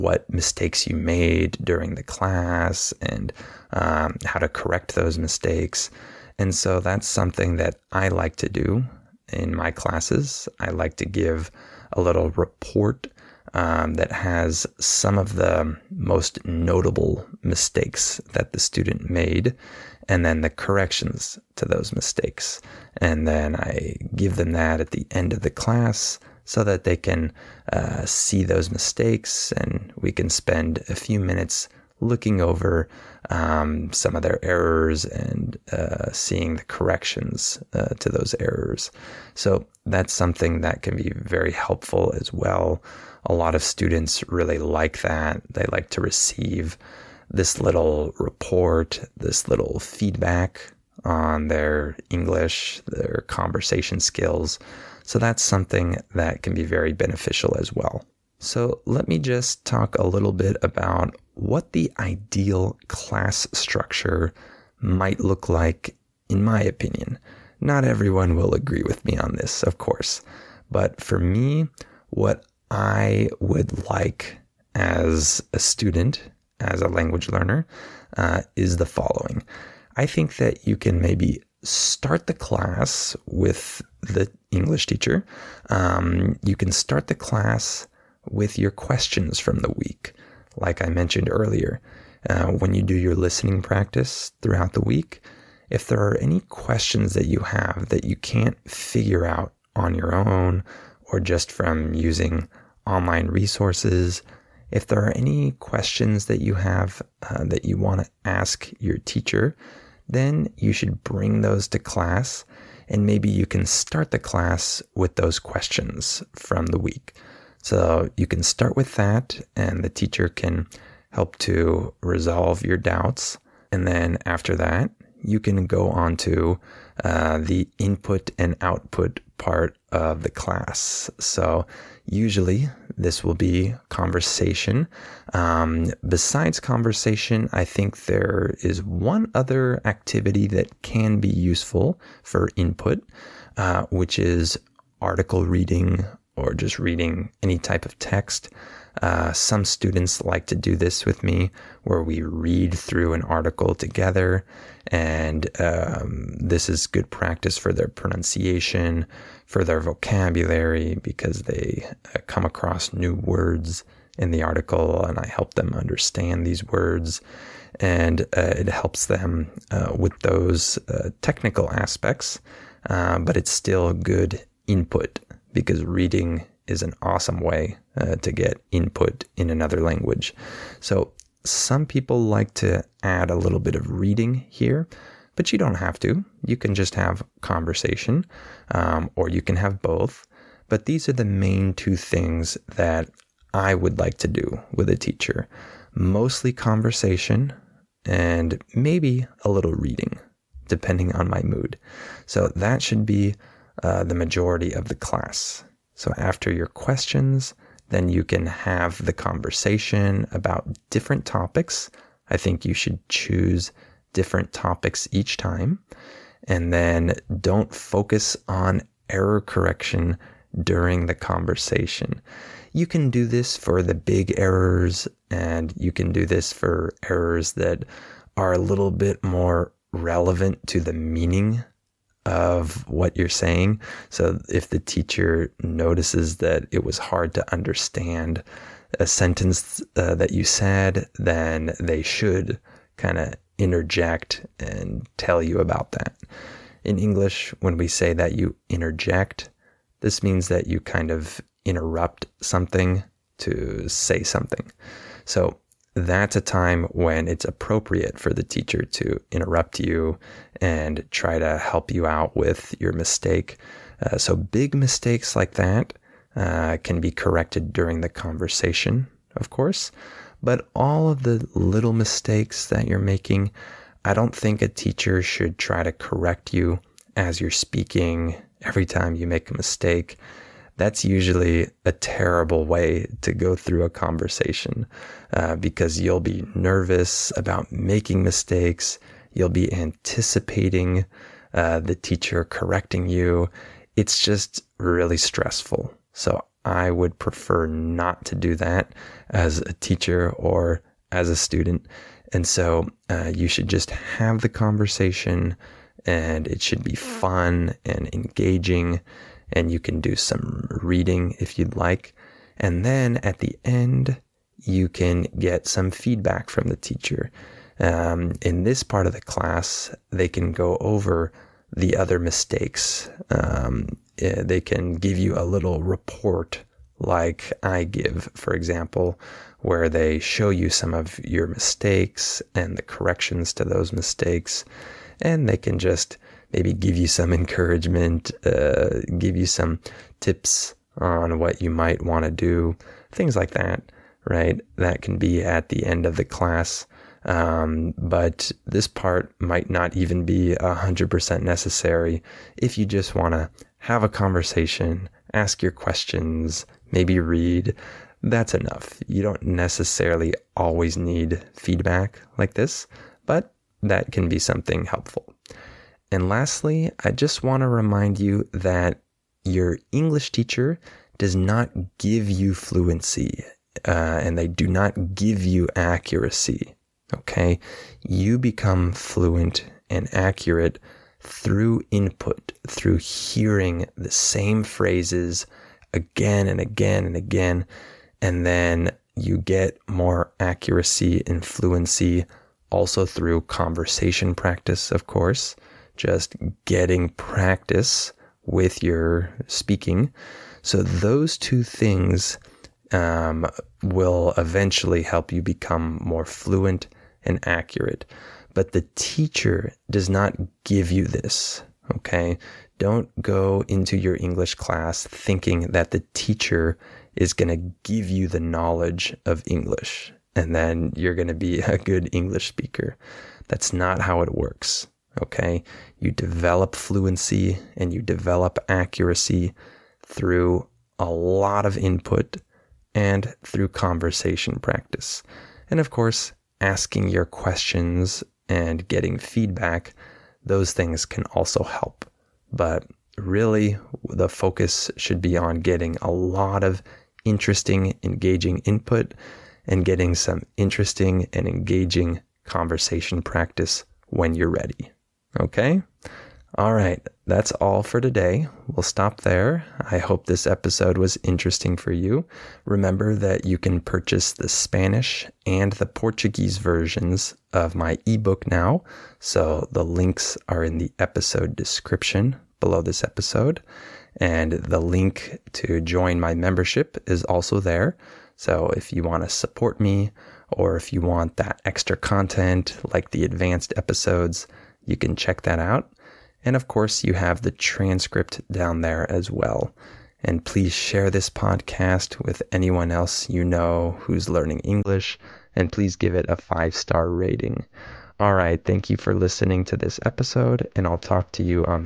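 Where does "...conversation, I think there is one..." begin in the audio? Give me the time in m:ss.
2:16.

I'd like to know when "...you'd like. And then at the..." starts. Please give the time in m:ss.
5:11.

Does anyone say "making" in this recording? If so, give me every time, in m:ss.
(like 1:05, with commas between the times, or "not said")
4:32, 4:47.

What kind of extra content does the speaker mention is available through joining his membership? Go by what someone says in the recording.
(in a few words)
Advanced episodes.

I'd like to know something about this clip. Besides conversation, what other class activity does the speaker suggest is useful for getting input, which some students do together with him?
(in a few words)
Article reading.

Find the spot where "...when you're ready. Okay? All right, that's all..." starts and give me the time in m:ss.
7:34.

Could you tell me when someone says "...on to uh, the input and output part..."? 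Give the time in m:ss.
2:05.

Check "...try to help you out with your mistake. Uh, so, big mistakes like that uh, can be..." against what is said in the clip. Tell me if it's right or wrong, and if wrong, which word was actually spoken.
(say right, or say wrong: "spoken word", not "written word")
right.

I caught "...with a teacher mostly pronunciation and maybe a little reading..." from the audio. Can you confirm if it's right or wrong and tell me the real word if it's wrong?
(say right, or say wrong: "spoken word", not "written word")
wrong: "conversation", not "pronunciation".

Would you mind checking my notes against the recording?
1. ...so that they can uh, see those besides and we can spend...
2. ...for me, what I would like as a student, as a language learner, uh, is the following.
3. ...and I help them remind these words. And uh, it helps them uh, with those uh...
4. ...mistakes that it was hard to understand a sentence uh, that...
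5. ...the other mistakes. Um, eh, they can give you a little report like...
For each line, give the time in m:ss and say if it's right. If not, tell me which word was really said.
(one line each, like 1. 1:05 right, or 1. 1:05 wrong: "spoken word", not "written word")
1. 0:26 wrong: "mistakes", not "besides"
2. 1:11 right
3. 2:45 wrong: "understand", not "remind"
4. 3:55 wrong: "notices", not "mistakes"
5. 5:21 right.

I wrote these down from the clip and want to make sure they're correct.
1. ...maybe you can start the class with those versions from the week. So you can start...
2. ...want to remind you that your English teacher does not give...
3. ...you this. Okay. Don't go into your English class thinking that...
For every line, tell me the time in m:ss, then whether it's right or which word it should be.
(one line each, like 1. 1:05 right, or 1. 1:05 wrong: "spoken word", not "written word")
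1. 1:53 wrong: "questions", not "versions"
2. 6:07 right
3. 6:50 right.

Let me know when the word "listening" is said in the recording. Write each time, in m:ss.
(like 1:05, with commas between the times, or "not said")
1:33, 8:19.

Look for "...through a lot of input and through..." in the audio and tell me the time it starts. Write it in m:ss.
7:10.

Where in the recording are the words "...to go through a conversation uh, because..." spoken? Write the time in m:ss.
4:43.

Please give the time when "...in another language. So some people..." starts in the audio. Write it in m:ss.
2:59.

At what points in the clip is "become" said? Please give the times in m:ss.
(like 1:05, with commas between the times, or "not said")
6:18, 6:45.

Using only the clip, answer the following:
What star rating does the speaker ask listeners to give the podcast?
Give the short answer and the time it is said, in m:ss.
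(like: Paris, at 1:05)
5, at 8:16.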